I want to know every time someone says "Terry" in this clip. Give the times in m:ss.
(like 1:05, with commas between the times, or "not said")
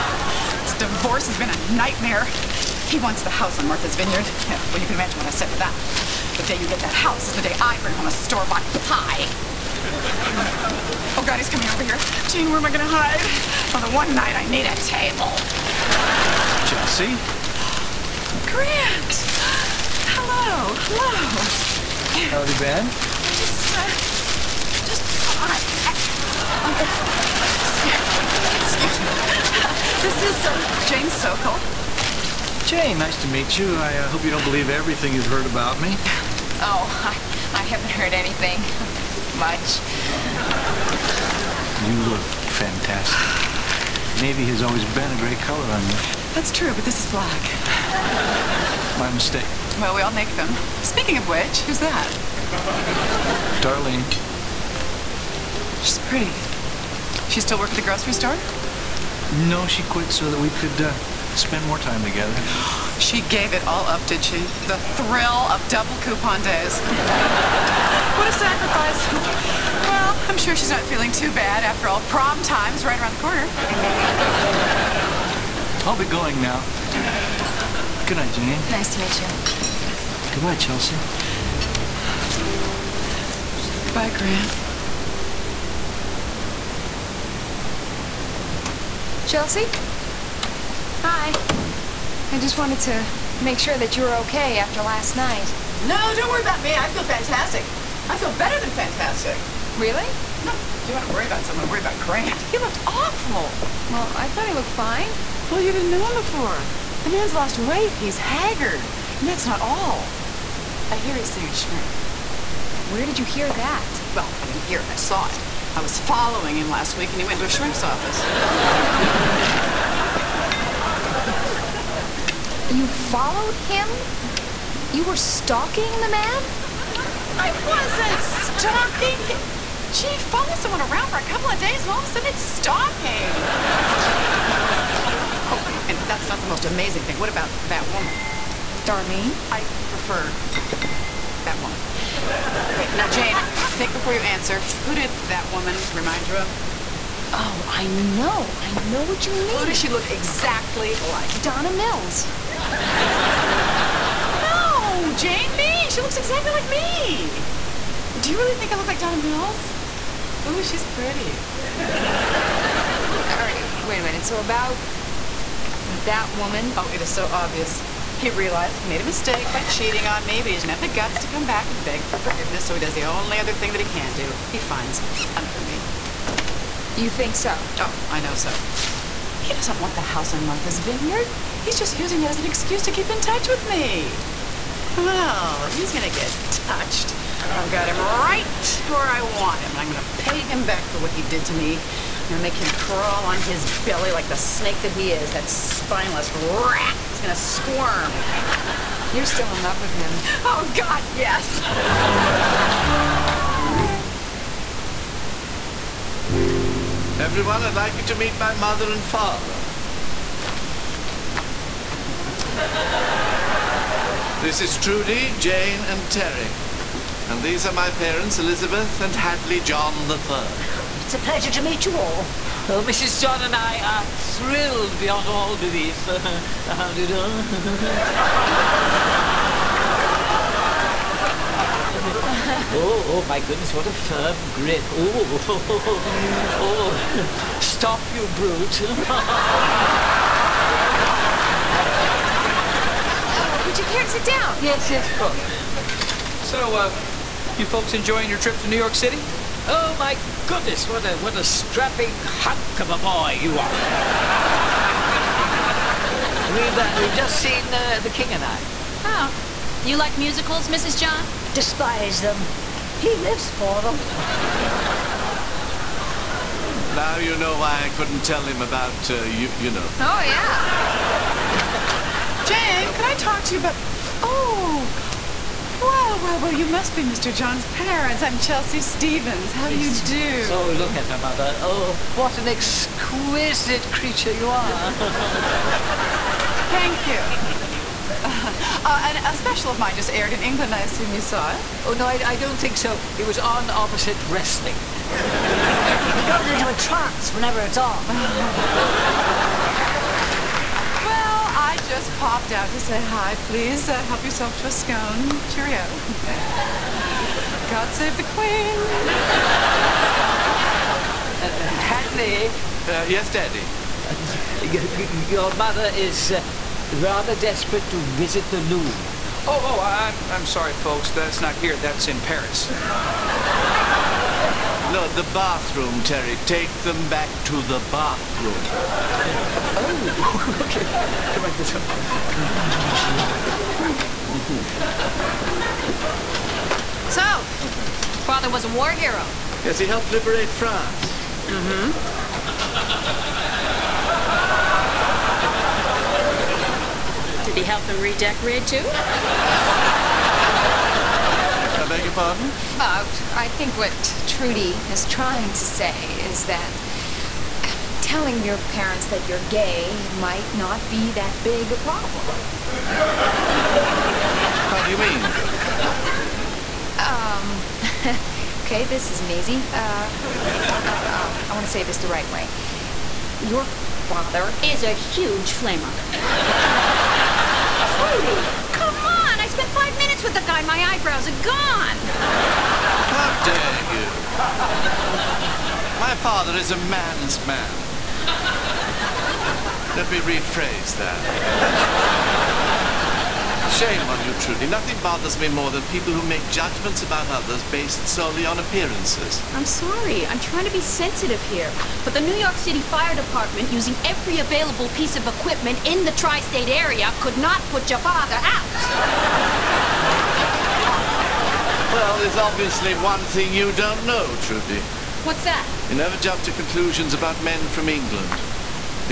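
3:36, 5:26.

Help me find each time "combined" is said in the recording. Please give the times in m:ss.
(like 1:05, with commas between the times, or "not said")
not said.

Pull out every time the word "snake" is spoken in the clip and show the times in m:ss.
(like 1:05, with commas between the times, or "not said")
3:14.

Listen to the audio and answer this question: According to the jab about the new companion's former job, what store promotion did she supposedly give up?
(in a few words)
Double coupon days.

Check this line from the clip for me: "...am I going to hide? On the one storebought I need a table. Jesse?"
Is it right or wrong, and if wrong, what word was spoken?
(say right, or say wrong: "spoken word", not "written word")
wrong: "night", not "storebought".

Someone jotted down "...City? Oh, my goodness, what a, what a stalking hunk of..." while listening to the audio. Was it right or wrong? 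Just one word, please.
wrong.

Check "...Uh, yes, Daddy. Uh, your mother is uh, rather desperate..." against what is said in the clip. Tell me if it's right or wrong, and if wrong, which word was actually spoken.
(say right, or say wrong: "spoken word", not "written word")
right.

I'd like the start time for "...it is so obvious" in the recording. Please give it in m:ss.
2:46.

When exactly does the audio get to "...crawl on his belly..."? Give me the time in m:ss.
3:12.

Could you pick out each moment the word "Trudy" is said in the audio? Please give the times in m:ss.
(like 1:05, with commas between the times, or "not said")
3:34, 5:54, 6:18, 6:34, 6:54.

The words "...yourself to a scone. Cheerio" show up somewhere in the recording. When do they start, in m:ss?
5:04.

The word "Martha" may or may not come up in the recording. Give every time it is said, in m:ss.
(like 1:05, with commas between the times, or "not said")
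0:03, 3:00.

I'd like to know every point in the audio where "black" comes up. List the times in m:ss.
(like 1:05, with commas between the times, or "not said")
0:47.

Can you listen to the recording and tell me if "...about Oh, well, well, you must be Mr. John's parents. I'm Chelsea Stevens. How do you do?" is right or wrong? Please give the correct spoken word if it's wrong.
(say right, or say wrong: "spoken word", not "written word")
right.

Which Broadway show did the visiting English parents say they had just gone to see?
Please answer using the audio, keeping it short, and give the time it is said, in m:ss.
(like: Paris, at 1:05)
The King and I, at 4:18.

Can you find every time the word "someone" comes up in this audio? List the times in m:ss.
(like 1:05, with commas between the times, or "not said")
1:41, 2:10.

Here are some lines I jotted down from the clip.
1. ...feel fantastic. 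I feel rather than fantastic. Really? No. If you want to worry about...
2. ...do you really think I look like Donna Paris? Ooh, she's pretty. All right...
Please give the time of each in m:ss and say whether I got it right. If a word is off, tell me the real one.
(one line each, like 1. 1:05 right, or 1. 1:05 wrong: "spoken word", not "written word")
1. 1:36 wrong: "better", not "rather"
2. 2:38 wrong: "Mills", not "Paris".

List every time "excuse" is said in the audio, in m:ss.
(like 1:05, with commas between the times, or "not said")
0:28, 3:02.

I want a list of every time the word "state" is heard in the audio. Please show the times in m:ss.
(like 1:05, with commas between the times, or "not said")
6:46.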